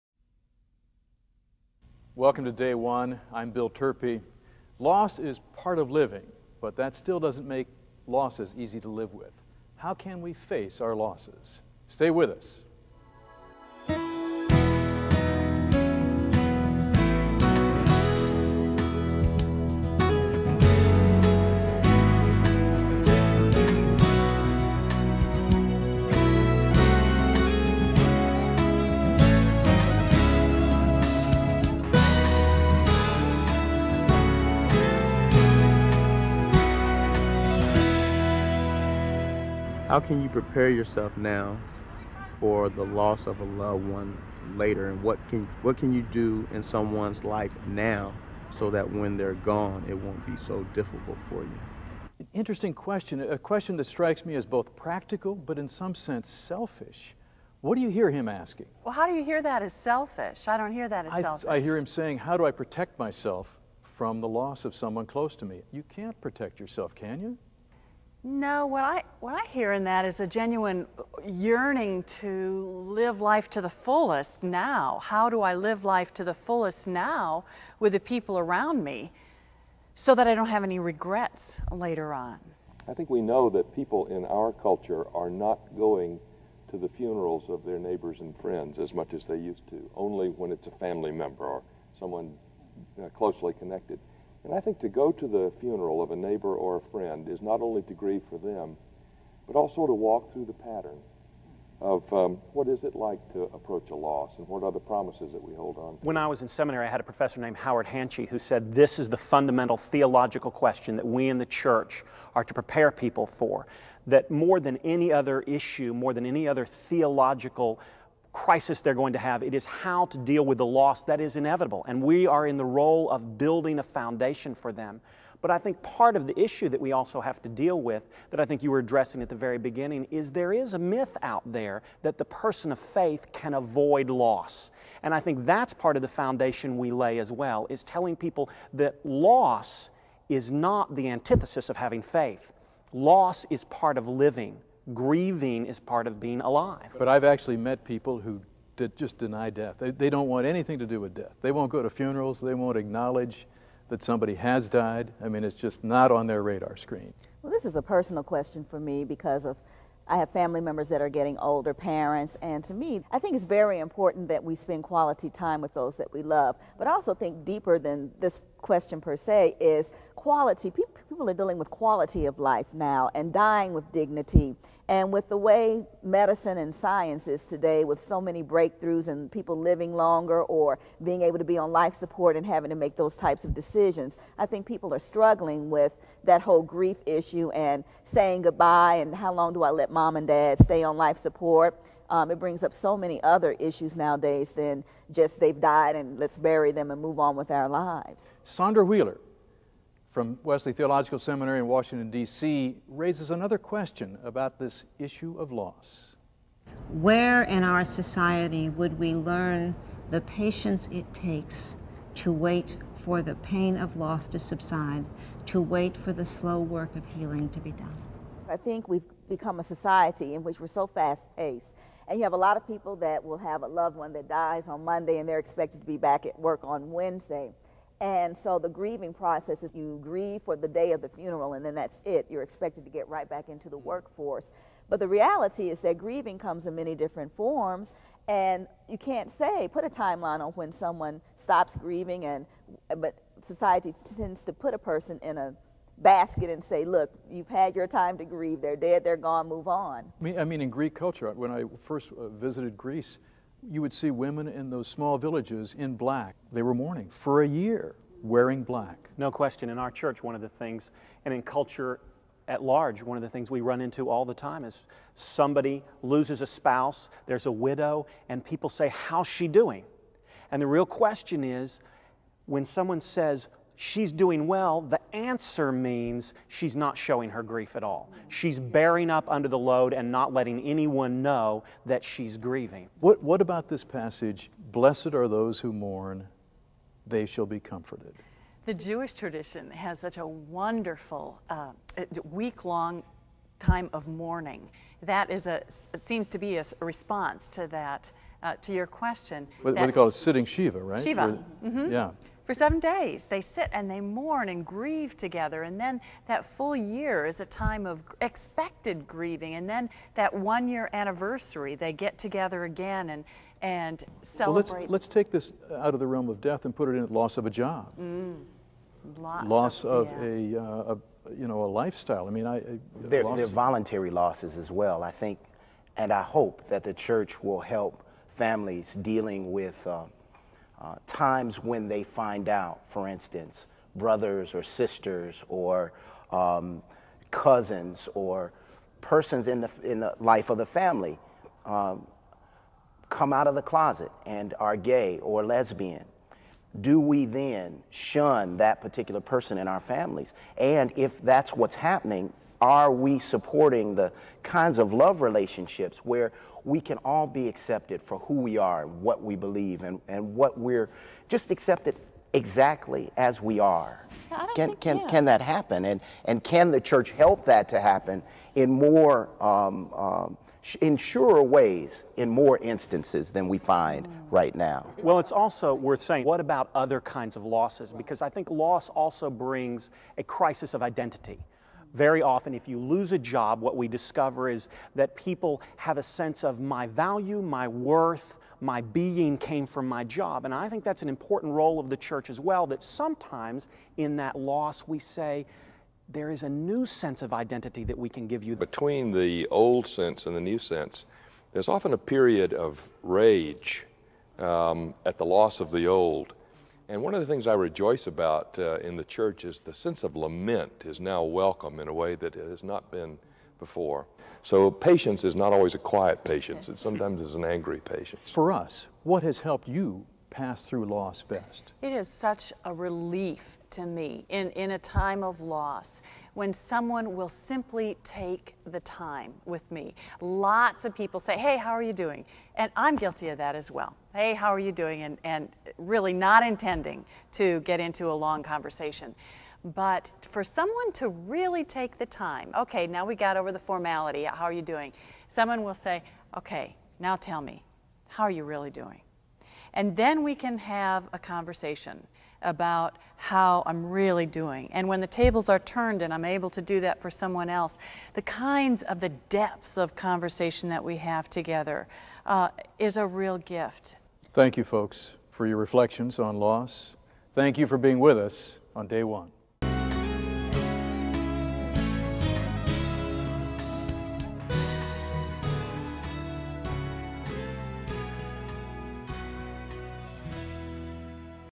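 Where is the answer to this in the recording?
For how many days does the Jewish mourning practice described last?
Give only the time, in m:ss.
5:02.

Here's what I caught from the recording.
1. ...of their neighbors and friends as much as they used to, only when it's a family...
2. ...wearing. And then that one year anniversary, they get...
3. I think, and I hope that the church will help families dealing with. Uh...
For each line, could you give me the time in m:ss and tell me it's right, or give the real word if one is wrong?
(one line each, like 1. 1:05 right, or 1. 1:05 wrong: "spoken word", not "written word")
1. 1:27 right
2. 5:09 wrong: "grieving", not "wearing"
3. 5:25 right.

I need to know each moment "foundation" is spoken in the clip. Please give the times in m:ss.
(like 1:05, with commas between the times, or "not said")
2:03, 2:16.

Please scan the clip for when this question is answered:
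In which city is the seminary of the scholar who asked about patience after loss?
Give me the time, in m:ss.
3:21.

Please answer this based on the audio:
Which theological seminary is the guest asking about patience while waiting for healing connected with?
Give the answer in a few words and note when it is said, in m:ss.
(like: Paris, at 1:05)
Wesley Theological Seminary, at 3:20.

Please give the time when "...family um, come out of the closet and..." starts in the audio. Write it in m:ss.
5:40.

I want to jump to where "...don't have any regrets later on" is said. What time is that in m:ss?
1:20.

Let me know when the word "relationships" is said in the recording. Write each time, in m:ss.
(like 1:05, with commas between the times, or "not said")
5:55.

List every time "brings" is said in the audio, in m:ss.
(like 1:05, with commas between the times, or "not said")
3:12, 6:19.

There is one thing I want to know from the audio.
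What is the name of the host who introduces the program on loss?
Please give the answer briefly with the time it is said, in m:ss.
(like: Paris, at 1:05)
Bill Turpie, at 0:03.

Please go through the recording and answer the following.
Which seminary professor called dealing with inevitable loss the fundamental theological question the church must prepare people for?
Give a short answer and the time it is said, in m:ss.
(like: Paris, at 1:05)
Howard Hanchey, at 1:47.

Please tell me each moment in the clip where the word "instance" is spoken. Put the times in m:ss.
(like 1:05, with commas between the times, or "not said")
5:33, 6:12.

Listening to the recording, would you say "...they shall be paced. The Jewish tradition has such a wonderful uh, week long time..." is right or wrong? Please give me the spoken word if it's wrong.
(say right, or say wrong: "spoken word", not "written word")
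wrong: "comforted", not "paced".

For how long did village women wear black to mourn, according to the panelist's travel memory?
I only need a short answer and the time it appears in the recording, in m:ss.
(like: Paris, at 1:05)
A year, at 4:17.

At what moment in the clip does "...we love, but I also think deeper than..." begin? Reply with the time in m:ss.
2:46.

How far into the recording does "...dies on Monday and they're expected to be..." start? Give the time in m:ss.
3:44.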